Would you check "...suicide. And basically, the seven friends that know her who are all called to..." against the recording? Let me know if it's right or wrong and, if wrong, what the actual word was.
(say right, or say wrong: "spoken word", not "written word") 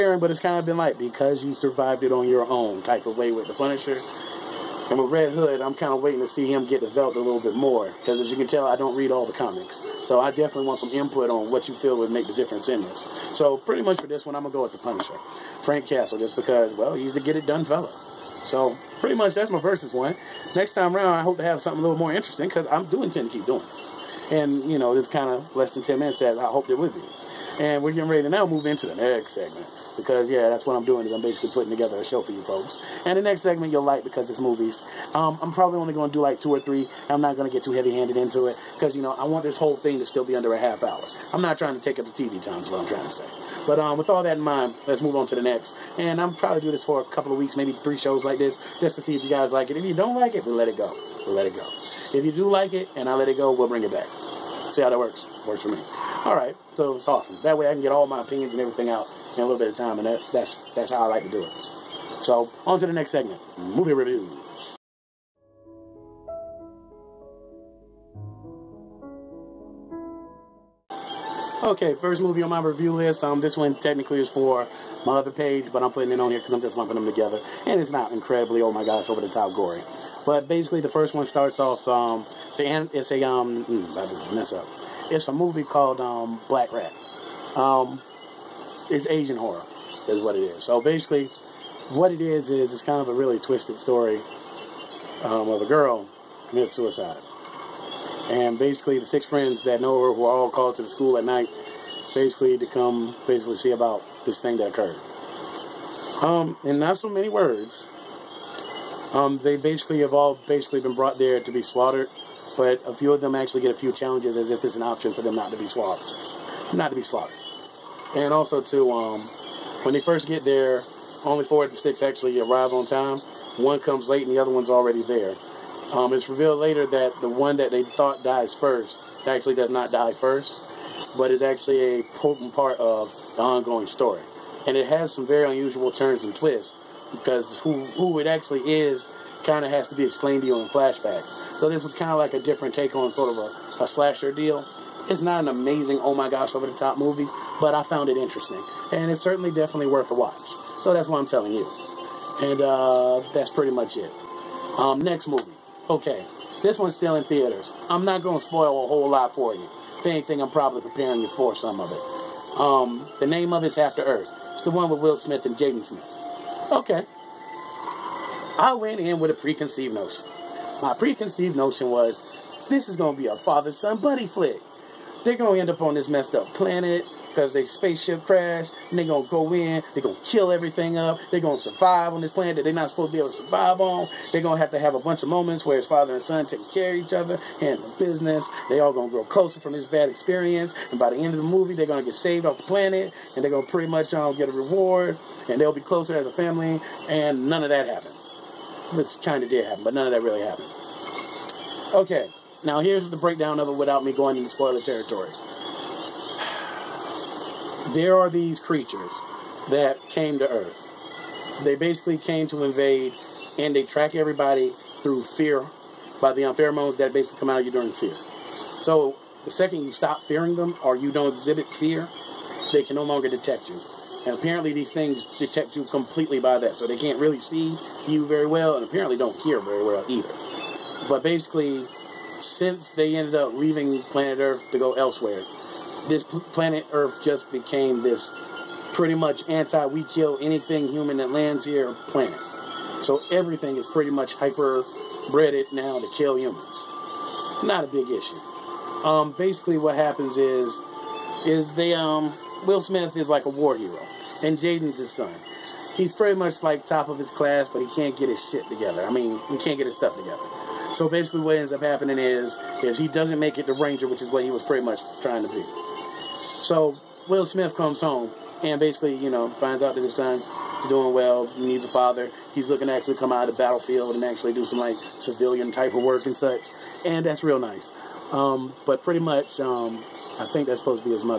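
wrong: "six", not "seven".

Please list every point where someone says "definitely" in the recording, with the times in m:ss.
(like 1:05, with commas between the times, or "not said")
0:10, 2:29.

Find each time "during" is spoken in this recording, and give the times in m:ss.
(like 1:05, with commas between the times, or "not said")
3:37.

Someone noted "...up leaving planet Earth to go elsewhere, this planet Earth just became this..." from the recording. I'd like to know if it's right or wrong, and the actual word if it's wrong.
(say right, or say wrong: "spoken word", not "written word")
right.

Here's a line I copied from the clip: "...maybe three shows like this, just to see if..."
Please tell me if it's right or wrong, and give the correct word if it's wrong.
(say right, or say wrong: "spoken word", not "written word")
right.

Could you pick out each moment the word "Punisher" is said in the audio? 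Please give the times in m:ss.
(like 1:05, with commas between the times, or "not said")
0:03, 0:14.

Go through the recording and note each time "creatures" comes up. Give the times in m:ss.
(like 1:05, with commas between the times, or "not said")
3:28.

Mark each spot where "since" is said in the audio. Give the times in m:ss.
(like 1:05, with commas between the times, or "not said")
3:51.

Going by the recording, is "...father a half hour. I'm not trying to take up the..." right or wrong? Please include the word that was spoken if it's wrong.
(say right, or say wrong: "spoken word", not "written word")
wrong: "under", not "father".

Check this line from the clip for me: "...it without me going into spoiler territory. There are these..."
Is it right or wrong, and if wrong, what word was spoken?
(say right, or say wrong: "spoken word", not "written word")
right.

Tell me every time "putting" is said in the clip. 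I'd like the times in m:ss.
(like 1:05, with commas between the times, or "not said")
0:31, 1:15.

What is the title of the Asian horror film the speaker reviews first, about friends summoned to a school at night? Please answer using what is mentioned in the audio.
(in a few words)
Black Rat.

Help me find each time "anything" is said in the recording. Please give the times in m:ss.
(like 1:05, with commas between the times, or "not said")
2:40, 4:00.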